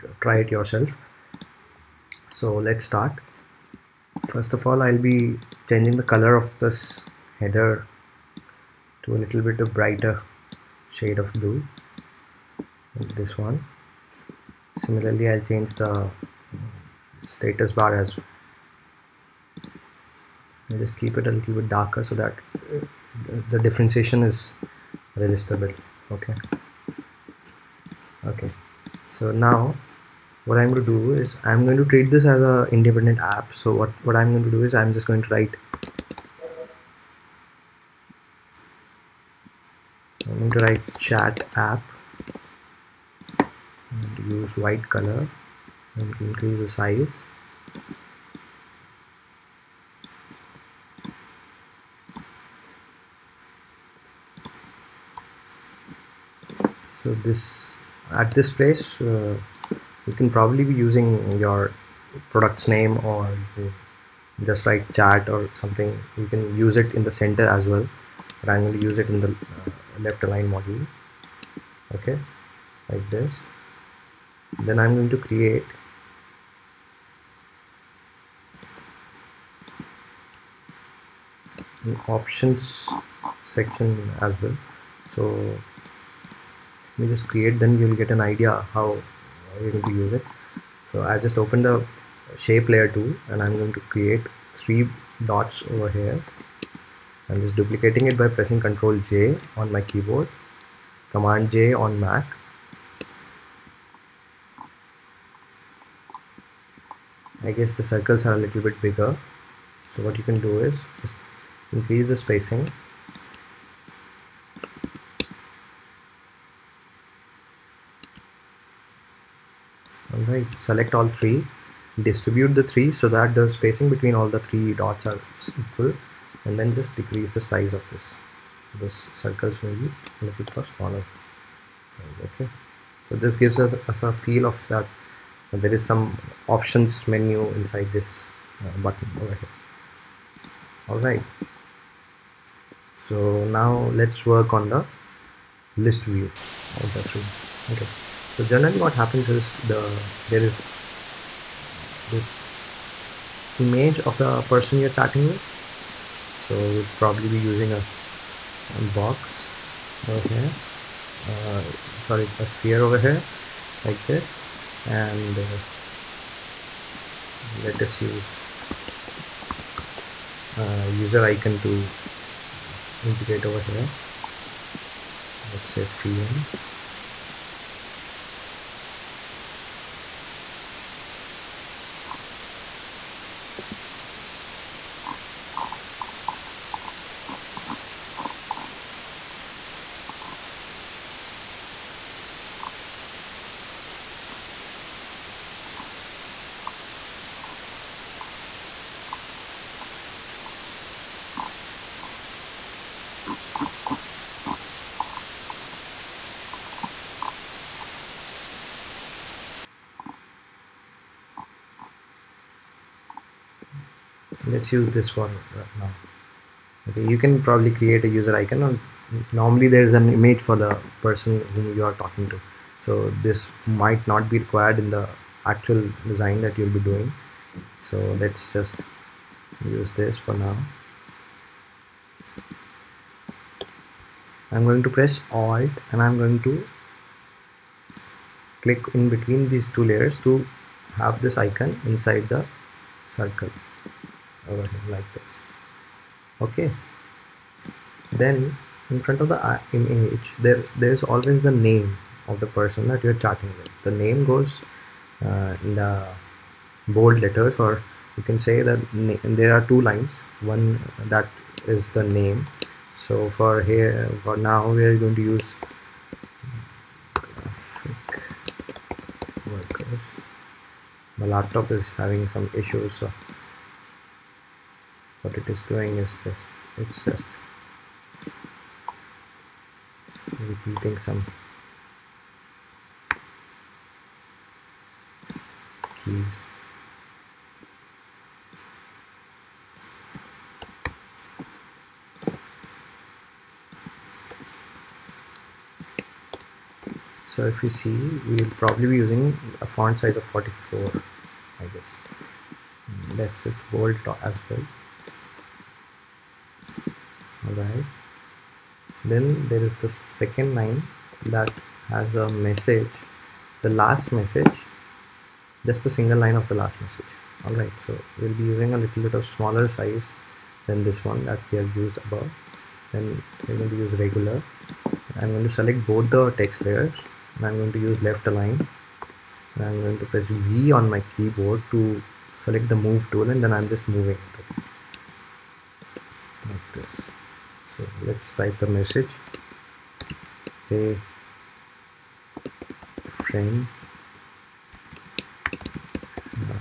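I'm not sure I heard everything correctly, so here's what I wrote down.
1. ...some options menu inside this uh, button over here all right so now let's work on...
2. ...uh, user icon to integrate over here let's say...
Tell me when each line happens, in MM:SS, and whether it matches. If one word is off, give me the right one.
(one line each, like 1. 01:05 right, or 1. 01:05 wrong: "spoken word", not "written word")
1. 02:15 right
2. 02:50 right.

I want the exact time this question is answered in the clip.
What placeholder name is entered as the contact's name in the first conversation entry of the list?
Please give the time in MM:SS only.
04:27.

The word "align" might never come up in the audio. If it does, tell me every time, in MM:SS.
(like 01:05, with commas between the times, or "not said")
01:10, 05:28.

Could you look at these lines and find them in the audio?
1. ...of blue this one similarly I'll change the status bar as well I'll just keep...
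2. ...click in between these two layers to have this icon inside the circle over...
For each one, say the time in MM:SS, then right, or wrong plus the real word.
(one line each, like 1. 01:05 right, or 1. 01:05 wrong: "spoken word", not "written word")
1. 00:11 right
2. 03:58 right.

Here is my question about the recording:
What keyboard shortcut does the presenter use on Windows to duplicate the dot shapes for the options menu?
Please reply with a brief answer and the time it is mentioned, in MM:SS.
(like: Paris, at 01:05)
Ctrl J, at 01:38.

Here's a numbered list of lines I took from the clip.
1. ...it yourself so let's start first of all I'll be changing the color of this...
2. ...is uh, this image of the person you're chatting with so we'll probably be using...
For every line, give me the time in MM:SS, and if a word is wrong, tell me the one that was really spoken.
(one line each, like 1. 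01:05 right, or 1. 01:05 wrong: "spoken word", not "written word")
1. 00:00 right
2. 02:30 right.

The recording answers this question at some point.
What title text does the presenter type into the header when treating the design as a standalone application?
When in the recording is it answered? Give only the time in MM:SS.
00:40.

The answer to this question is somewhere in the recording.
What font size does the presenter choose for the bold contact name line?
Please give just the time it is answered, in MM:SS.
05:00.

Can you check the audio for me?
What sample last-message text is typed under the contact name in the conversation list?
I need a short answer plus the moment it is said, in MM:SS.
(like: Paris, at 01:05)
hey friend, at 05:40.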